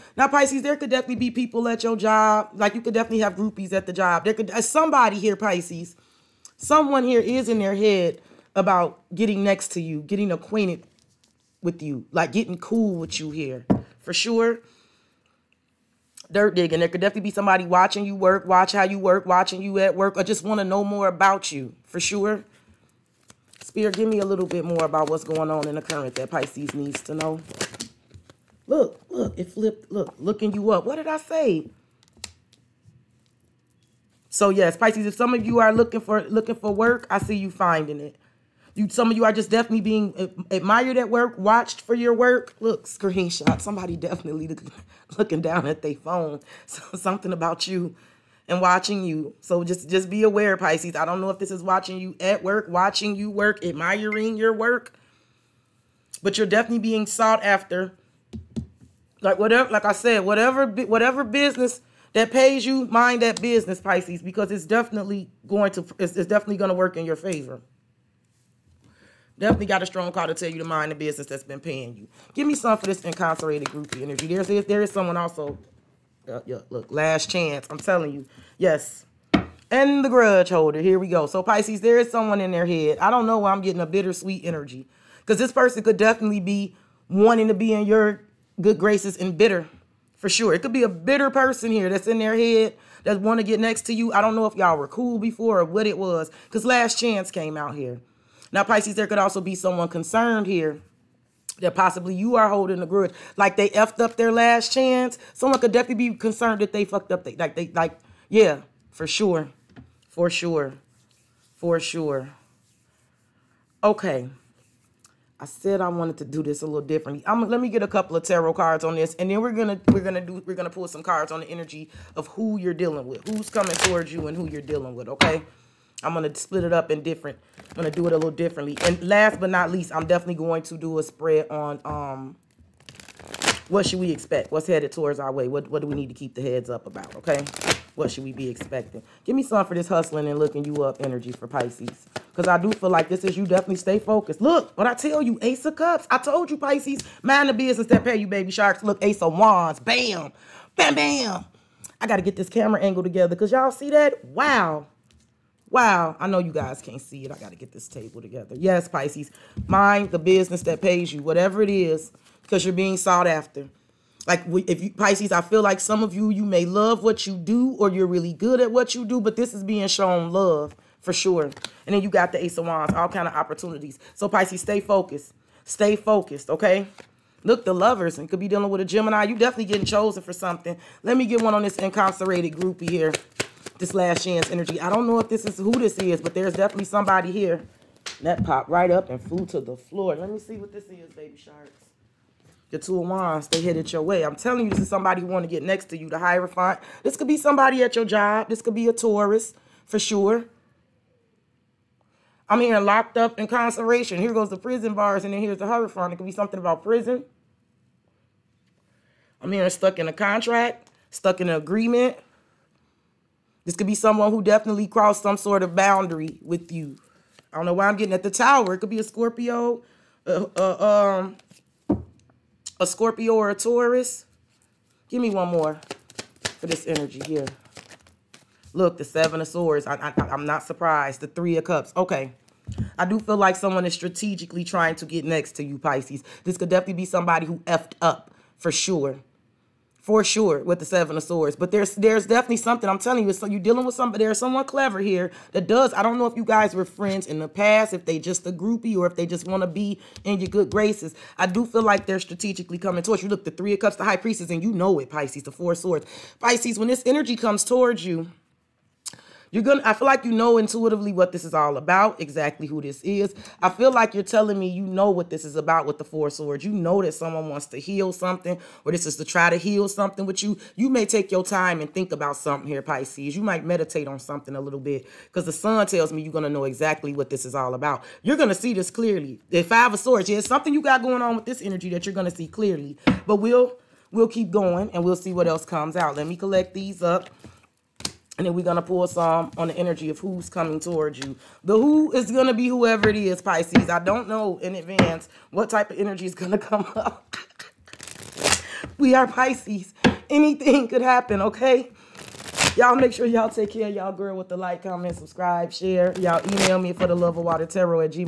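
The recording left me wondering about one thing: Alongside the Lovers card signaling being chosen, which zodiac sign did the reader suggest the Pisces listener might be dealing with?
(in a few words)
Gemini.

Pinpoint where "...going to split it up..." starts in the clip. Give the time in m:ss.
2:06.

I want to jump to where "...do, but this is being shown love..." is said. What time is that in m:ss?
2:49.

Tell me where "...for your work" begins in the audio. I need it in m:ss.
0:41.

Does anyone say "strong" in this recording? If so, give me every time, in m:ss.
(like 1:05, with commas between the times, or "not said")
1:09.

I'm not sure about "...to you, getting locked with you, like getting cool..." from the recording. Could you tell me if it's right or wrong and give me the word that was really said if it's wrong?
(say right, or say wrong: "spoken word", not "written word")
wrong: "acquainted", not "locked".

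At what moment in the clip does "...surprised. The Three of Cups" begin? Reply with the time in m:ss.
3:50.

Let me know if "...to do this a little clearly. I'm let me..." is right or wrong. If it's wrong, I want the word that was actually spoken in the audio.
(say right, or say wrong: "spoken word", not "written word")
wrong: "differently", not "clearly".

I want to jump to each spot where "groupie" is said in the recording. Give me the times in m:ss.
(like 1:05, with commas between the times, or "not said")
0:03, 1:13, 3:02, 4:08.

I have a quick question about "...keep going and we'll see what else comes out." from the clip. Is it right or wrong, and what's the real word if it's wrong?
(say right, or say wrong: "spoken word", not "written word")
right.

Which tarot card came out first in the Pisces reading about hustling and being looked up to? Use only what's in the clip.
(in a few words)
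Ace of Cups.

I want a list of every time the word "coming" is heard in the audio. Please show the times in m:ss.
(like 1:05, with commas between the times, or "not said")
2:03, 4:12, 4:50.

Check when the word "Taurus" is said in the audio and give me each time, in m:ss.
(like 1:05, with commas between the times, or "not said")
3:18, 3:43.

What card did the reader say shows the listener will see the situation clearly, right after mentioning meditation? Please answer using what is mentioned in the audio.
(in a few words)
The Sun.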